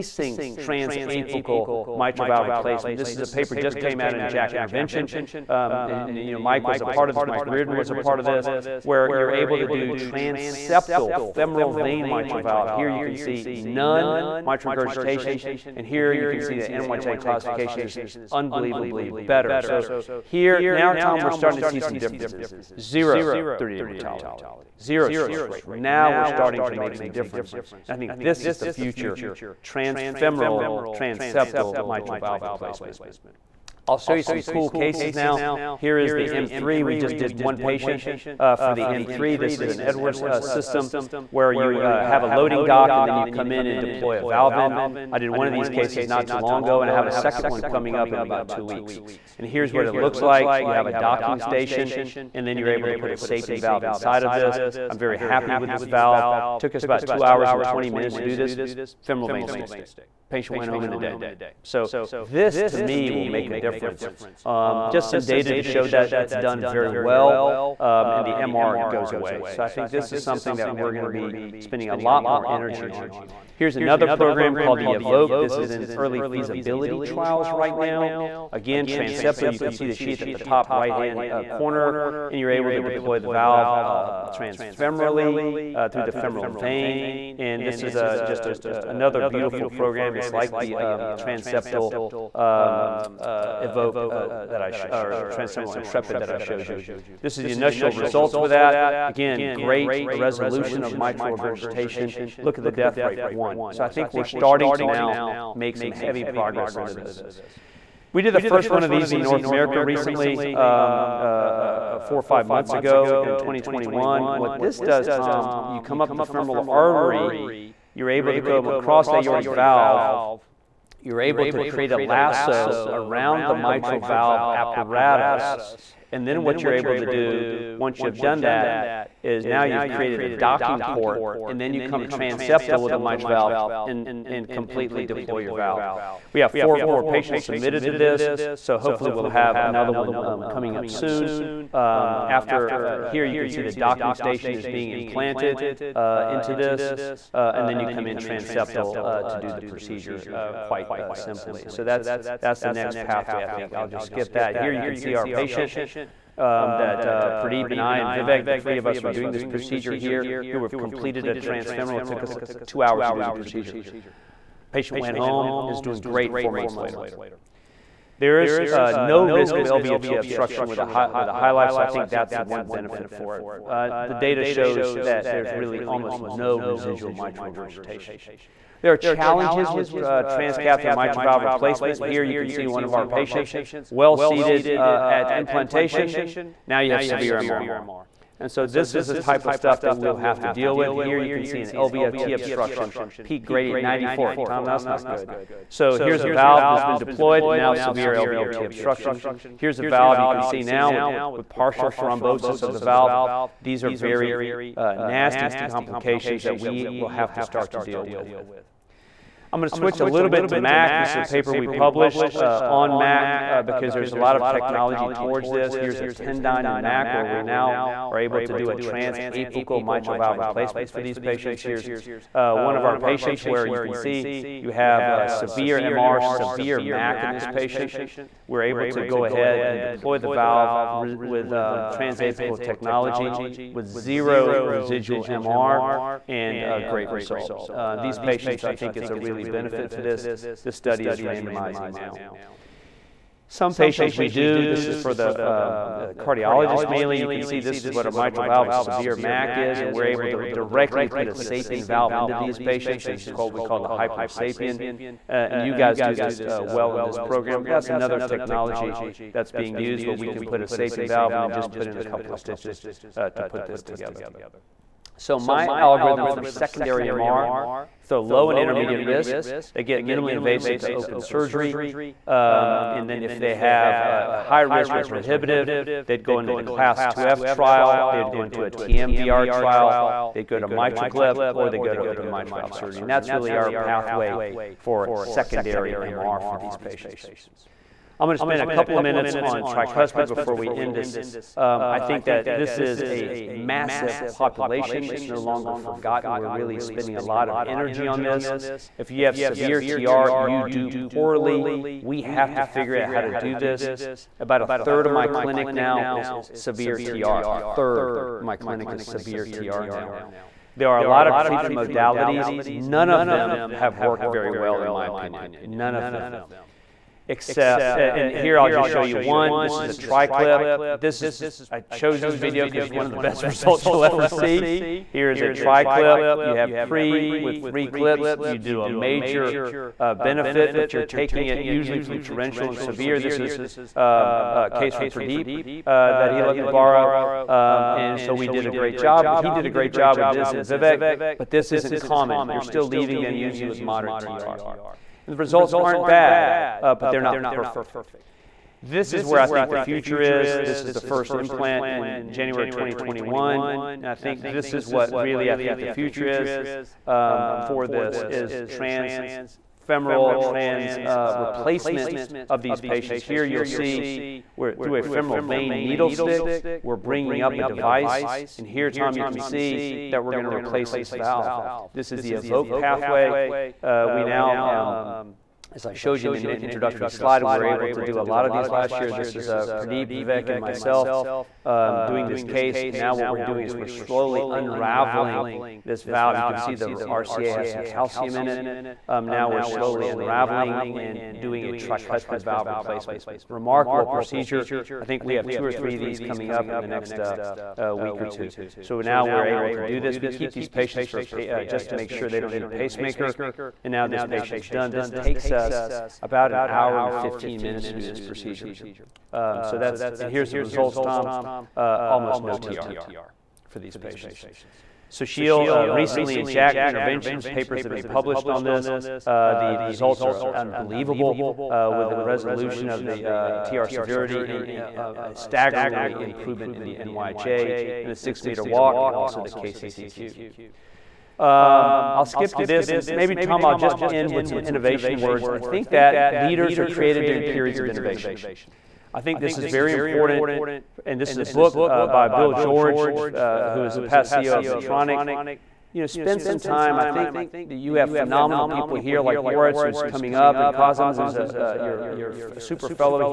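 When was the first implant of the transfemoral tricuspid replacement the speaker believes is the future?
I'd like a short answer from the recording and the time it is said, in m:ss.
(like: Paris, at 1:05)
January 2021, at 5:52.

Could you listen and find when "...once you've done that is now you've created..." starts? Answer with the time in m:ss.
2:07.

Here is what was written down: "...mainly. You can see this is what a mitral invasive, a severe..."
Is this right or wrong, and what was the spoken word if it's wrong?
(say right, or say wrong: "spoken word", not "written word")
wrong: "valve", not "invasive".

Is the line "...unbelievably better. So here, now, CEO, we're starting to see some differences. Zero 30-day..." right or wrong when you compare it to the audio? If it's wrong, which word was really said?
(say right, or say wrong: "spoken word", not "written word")
wrong: "Tom", not "CEO".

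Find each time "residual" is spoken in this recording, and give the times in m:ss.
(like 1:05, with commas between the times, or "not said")
2:56, 3:54.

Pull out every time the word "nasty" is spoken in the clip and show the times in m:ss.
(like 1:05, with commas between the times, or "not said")
3:24.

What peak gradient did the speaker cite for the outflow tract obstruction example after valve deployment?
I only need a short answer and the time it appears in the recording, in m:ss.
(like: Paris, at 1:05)
94, at 3:13.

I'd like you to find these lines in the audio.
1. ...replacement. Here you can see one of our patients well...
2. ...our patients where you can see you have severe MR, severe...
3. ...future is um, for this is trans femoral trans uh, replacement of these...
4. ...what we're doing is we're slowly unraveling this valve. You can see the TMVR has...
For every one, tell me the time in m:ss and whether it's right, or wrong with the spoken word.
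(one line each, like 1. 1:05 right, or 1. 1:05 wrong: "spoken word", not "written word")
1. 3:01 right
2. 3:42 right
3. 5:55 right
4. 6:23 wrong: "RCA", not "TMVR".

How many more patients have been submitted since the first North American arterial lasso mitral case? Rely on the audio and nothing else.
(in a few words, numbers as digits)
4.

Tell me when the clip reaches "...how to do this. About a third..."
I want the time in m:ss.
5:03.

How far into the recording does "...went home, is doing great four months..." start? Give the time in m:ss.
2:44.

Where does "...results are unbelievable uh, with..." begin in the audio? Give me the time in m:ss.
6:59.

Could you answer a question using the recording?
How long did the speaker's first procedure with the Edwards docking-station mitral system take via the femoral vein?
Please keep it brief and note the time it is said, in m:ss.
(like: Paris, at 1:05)
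2 hours 20 minutes, at 0:57.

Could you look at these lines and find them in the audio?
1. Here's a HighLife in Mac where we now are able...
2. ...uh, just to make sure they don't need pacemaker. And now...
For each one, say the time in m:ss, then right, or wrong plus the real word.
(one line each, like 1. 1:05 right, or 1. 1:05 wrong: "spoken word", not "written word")
1. 3:35 wrong: "Tendyne", not "HighLife"
2. 6:41 right.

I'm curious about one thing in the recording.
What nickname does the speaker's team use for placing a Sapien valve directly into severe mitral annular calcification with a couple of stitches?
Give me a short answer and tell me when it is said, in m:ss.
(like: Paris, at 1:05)
hybrid sapien, at 4:13.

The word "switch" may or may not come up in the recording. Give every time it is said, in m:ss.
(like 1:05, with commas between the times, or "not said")
3:29.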